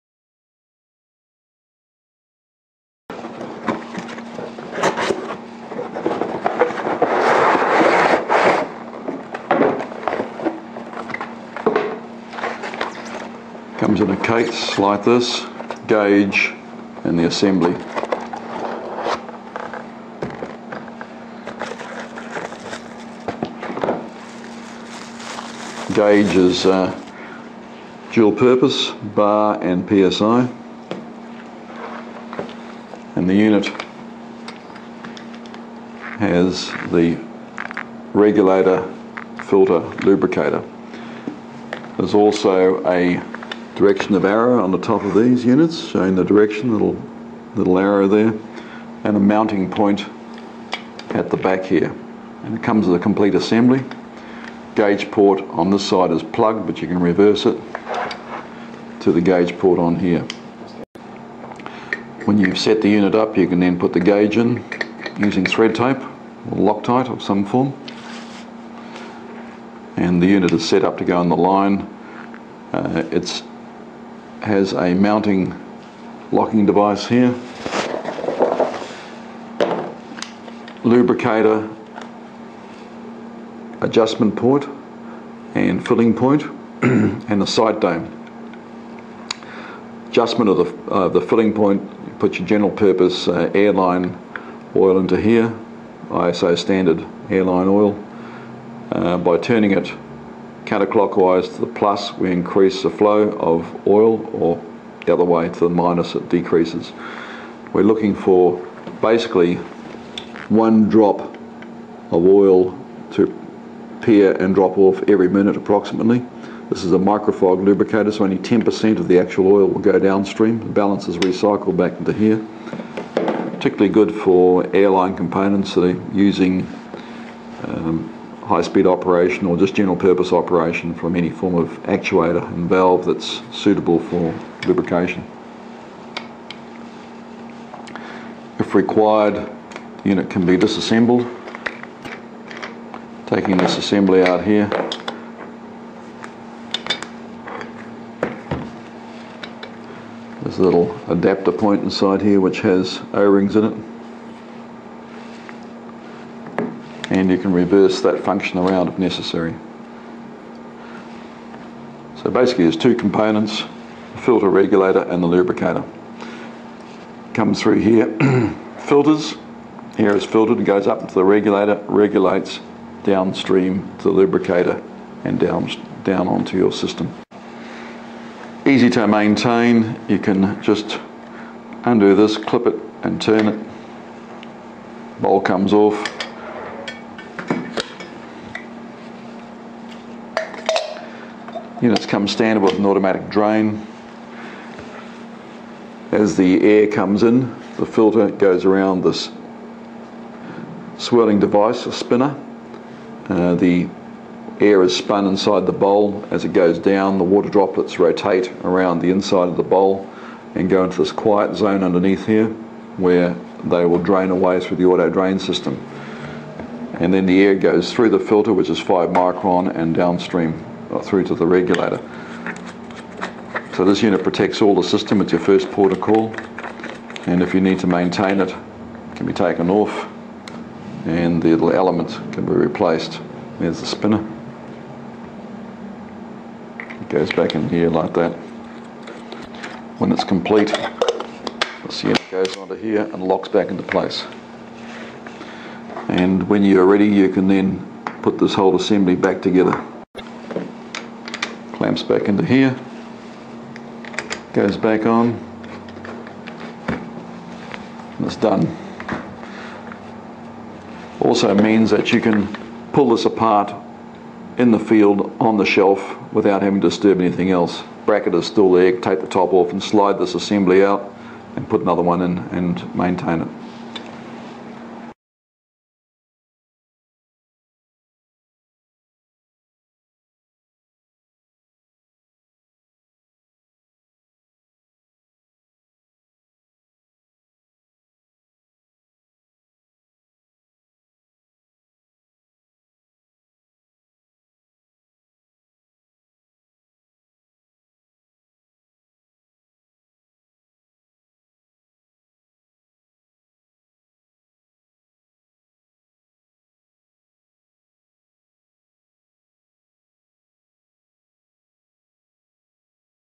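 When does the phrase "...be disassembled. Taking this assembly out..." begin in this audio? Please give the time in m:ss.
2:20.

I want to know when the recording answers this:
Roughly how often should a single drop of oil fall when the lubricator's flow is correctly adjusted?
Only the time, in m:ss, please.
1:55.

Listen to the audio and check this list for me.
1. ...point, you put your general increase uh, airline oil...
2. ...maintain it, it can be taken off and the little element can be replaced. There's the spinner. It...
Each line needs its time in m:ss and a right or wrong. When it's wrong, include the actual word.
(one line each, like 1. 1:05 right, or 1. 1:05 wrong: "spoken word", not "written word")
1. 1:31 wrong: "purpose", not "increase"
2. 3:47 right.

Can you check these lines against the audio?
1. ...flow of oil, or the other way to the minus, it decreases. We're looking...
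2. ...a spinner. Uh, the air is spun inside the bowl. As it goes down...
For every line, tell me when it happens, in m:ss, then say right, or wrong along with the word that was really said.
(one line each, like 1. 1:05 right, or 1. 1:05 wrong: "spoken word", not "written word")
1. 1:42 right
2. 3:21 right.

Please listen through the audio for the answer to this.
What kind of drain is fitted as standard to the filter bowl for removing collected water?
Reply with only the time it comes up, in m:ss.
3:12.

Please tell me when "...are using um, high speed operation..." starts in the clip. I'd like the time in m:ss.
2:05.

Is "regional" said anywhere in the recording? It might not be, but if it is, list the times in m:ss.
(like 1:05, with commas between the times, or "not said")
not said.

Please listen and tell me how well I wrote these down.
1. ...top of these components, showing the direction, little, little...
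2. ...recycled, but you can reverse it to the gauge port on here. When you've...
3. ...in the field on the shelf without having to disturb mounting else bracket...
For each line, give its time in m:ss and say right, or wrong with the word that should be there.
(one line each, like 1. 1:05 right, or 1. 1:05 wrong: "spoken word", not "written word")
1. 0:44 wrong: "units", not "components"
2. 0:56 wrong: "plugged", not "recycled"
3. 4:24 wrong: "anything", not "mounting".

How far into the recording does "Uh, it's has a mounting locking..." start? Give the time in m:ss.
1:12.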